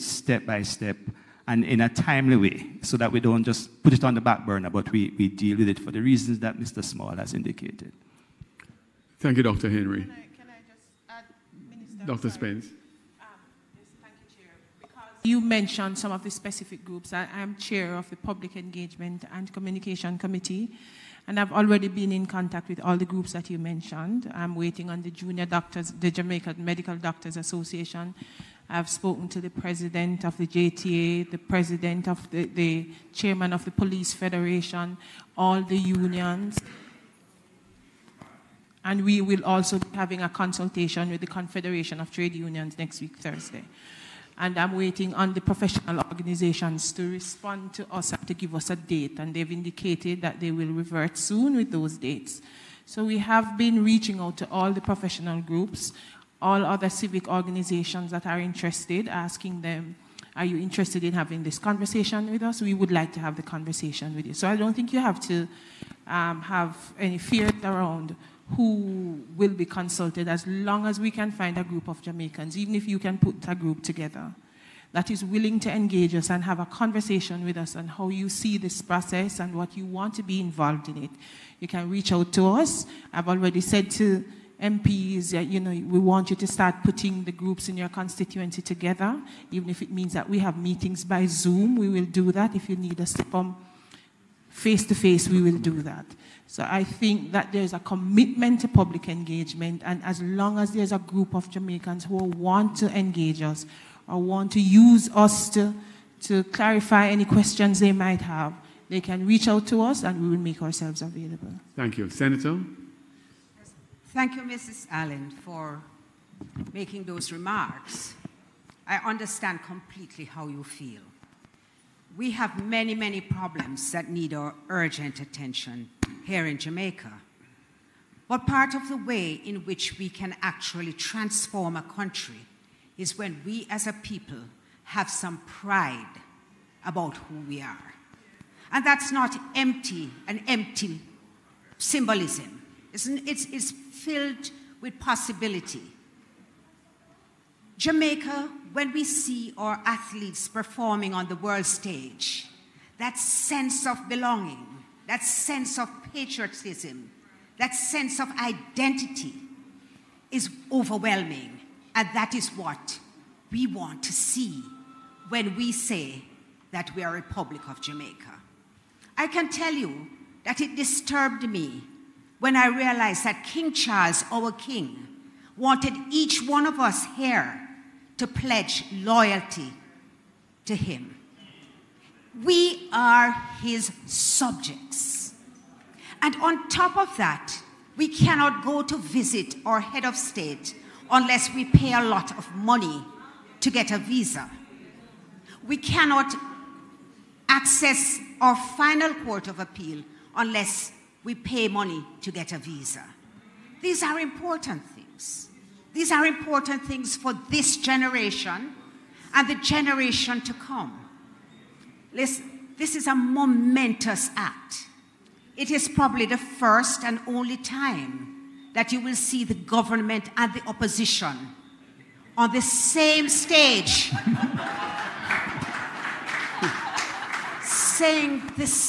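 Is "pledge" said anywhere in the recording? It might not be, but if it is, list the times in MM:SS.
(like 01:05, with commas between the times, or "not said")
02:58.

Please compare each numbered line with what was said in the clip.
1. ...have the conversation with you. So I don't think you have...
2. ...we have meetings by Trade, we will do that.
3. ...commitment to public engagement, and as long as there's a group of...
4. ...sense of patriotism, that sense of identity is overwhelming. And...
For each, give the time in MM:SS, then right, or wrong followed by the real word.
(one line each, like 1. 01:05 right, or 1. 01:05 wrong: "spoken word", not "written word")
1. 01:03 right
2. 01:30 wrong: "Zoom", not "Trade"
3. 01:37 right
4. 02:35 right.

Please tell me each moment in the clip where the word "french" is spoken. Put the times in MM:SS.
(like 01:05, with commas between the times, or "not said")
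not said.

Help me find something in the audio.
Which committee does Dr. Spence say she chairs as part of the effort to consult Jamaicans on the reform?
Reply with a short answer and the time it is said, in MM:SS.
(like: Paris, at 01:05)
Public Engagement and Communication Committee, at 00:18.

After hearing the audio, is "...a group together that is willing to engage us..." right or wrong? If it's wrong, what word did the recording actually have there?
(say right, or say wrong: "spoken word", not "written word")
right.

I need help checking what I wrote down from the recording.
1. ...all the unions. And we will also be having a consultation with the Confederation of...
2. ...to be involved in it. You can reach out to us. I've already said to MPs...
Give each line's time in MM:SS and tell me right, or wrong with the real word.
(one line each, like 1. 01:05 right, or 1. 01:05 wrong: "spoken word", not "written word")
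1. 00:35 right
2. 01:20 right.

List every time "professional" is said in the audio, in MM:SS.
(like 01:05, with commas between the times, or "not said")
00:45, 00:54.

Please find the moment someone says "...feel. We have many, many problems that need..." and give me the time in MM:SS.
02:00.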